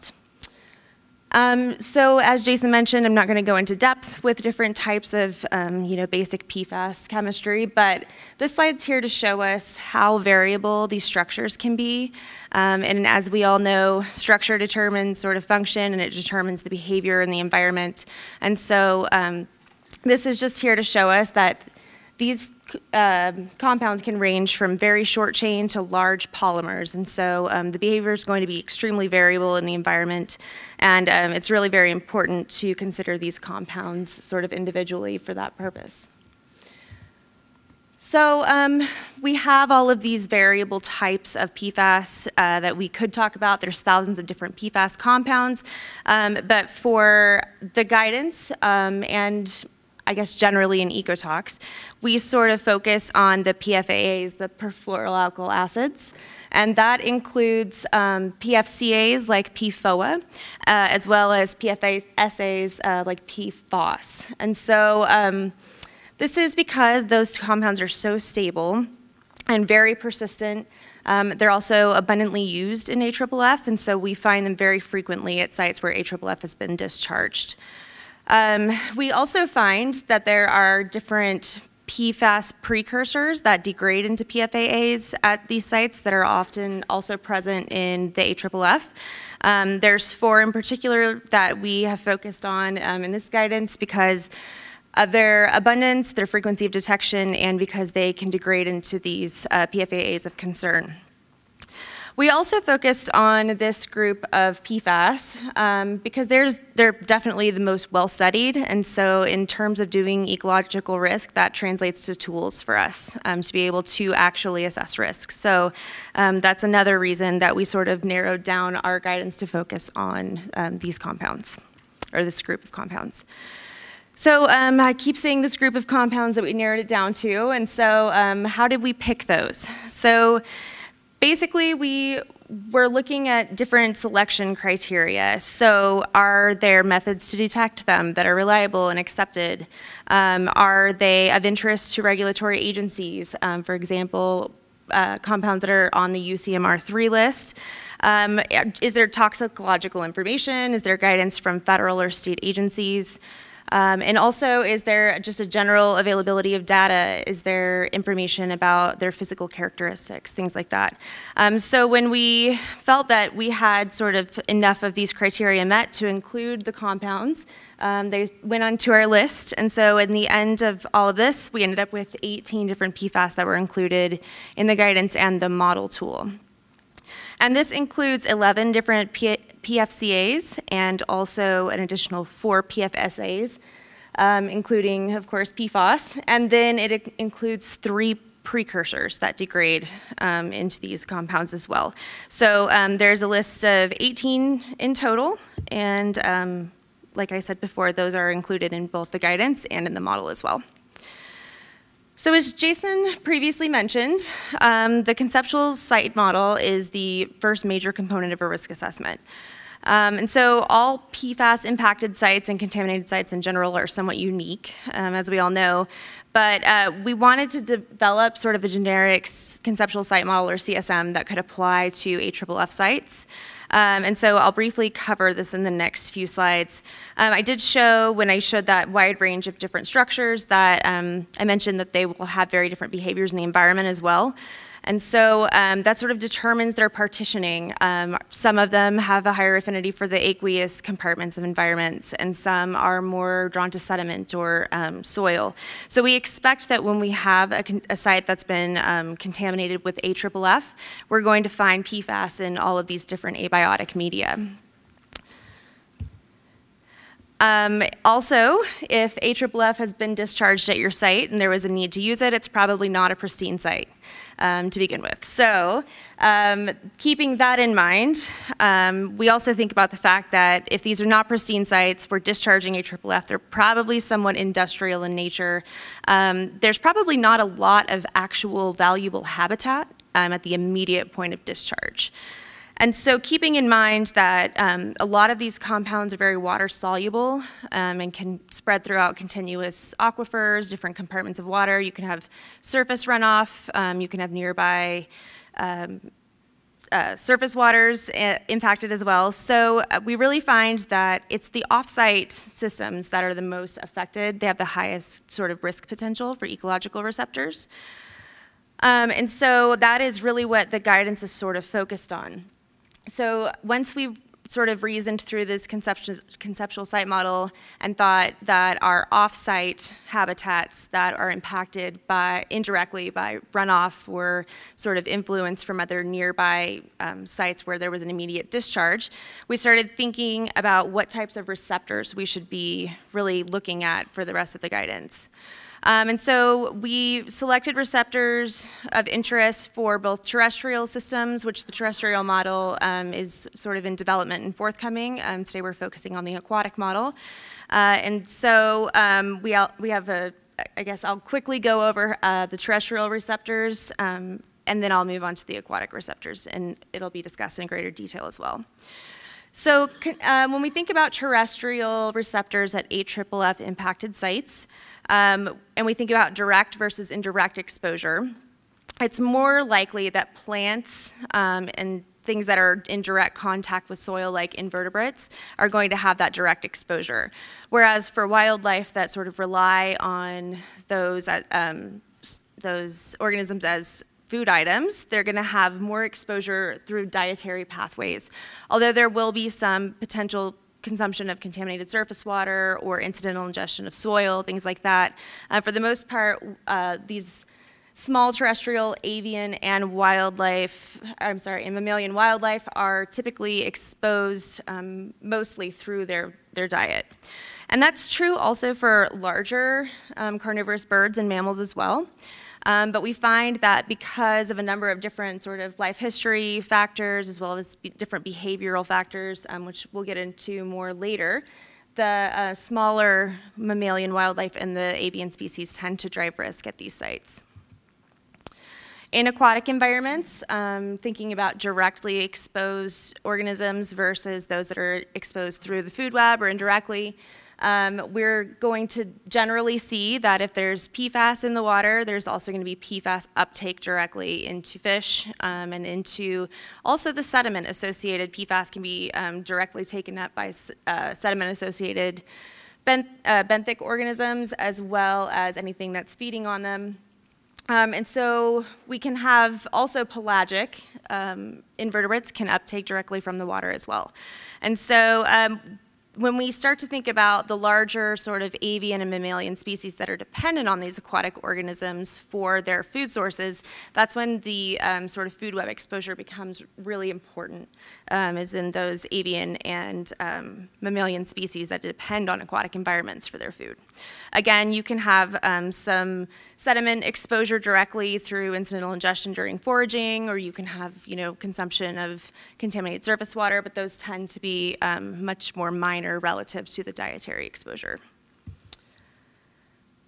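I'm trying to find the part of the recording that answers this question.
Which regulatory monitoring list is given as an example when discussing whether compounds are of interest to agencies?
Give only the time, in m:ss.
2:26.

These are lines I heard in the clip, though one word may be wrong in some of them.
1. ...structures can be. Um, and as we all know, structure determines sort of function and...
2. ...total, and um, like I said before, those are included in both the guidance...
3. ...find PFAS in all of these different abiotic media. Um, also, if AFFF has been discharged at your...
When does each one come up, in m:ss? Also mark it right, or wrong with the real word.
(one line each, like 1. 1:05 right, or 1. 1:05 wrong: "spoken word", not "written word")
1. 0:11 right
2. 3:14 right
3. 4:11 right.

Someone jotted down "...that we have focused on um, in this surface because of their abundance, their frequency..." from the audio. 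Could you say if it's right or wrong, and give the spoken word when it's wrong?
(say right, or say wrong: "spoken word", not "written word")
wrong: "guidance", not "surface".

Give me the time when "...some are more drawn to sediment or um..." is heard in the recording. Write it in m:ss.
4:02.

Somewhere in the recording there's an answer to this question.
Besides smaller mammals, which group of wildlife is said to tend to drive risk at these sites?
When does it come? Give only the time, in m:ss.
7:04.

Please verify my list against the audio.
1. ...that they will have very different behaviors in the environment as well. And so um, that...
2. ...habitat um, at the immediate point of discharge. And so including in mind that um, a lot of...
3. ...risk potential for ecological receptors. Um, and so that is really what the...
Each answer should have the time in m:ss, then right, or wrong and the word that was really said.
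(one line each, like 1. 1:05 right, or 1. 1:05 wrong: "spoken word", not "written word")
1. 3:51 right
2. 4:39 wrong: "keeping", not "including"
3. 5:05 right.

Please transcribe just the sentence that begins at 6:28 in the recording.
Although there will be some potential consumption of contaminated surface water or incidental ingestion of soil, things like that.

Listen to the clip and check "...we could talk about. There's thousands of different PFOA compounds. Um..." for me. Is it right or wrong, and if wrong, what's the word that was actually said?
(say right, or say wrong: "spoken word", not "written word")
wrong: "PFAS", not "PFOA".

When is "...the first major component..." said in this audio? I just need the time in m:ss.
3:26.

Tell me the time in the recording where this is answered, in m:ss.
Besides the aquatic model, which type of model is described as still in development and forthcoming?
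5:41.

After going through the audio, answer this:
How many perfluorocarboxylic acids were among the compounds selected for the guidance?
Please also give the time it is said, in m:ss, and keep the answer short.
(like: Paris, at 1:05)
11, at 2:58.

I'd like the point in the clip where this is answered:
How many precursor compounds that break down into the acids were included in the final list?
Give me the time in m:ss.
3:07.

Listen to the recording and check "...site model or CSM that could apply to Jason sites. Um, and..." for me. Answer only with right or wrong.
wrong.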